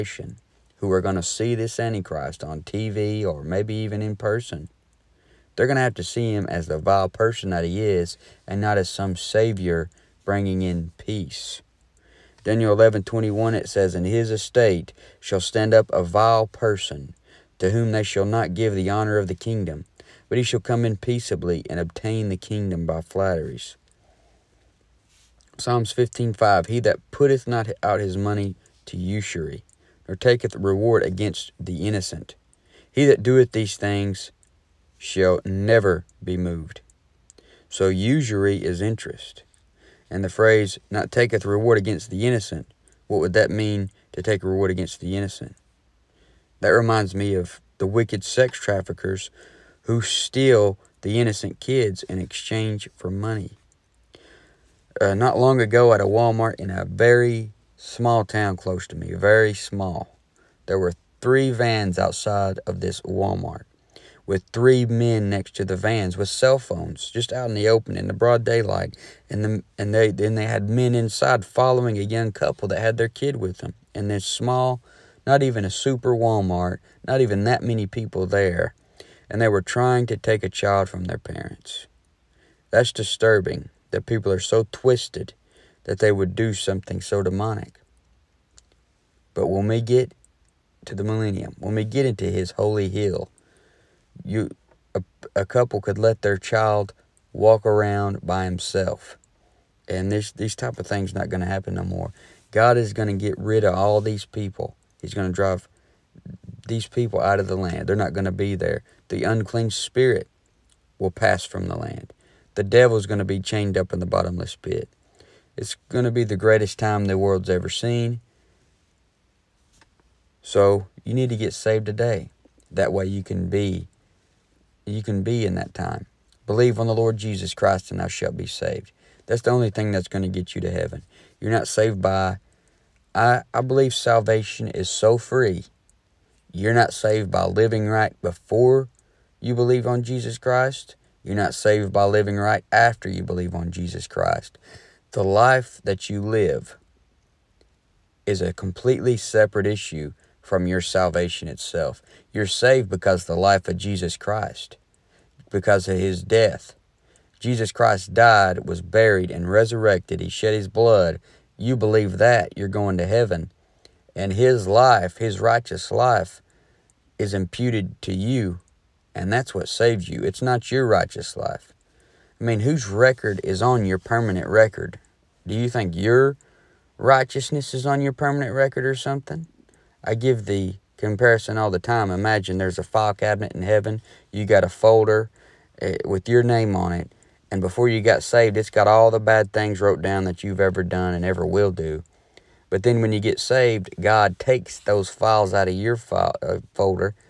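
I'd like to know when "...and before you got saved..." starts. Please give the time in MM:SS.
03:07.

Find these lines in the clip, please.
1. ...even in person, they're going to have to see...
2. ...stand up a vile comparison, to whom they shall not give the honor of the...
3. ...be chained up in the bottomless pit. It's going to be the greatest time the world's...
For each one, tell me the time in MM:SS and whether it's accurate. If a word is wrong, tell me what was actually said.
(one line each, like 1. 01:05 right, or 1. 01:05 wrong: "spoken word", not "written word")
1. 00:03 right
2. 00:15 wrong: "person", not "comparison"
3. 01:53 right.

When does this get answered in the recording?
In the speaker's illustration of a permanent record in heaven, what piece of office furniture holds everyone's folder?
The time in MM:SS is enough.
03:02.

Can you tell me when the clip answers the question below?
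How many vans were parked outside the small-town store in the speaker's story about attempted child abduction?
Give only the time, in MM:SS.
01:01.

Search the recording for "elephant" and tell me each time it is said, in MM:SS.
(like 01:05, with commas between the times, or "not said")
not said.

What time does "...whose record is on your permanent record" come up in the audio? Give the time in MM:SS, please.
02:52.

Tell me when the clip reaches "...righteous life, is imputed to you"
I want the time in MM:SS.
02:45.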